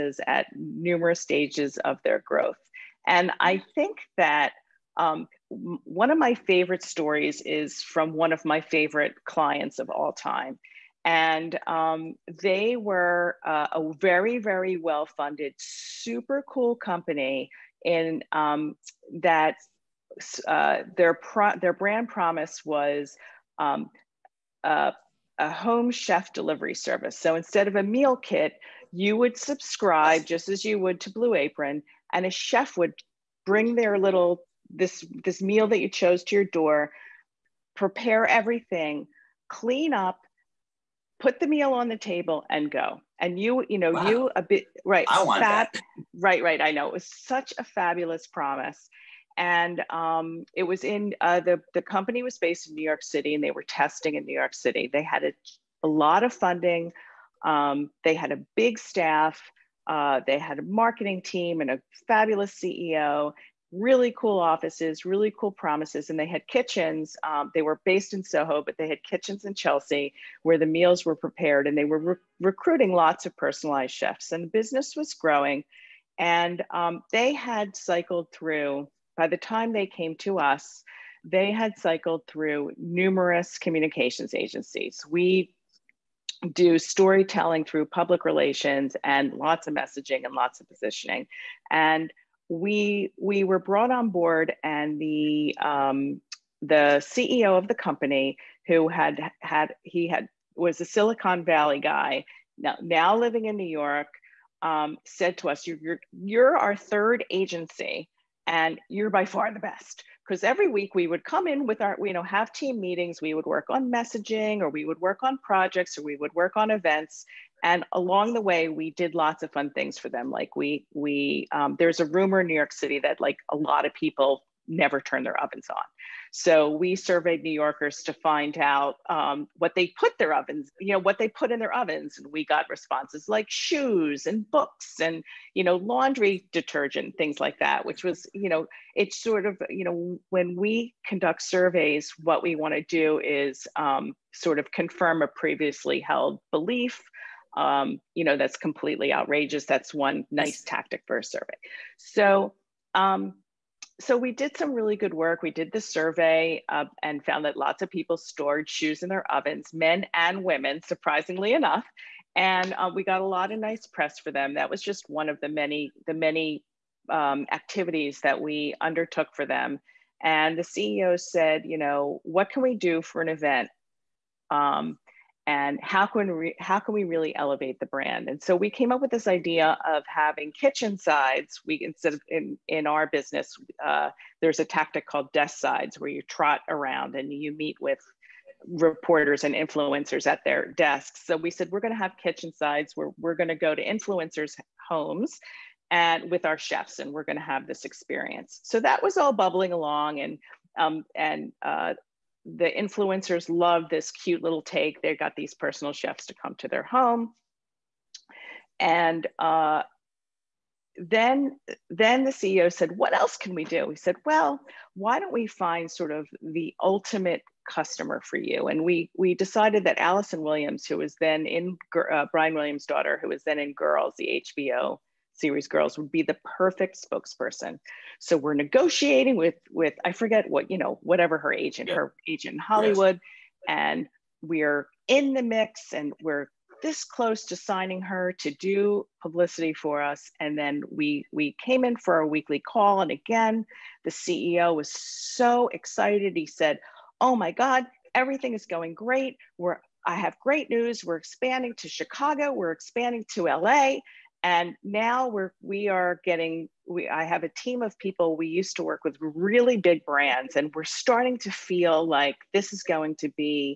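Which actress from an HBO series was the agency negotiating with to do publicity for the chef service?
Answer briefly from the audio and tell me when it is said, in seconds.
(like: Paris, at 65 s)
Allison Williams, at 219 s.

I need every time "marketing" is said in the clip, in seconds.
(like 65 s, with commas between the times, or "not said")
60 s.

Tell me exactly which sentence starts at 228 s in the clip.
So we're negotiating with with I forget what you know whatever her agent yeah.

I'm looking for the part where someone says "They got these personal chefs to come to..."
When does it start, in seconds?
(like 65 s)
205 s.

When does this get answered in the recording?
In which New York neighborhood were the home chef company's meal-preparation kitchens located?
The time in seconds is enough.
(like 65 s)
69 s.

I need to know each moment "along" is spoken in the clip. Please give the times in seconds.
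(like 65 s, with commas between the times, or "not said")
117 s, 199 s.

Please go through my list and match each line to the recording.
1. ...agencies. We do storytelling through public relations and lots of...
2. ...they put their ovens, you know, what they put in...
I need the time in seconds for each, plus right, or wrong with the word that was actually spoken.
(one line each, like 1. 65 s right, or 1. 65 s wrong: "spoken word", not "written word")
1. 84 s right
2. 129 s right.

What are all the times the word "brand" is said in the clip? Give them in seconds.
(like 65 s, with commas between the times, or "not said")
21 s, 177 s, 260 s.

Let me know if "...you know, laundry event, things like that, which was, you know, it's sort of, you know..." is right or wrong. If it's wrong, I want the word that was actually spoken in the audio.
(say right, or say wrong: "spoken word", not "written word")
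wrong: "detergent", not "event".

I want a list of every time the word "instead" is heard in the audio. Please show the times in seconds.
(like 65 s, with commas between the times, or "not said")
27 s, 181 s.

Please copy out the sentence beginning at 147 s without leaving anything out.
Um, you know, that's completely outrageous.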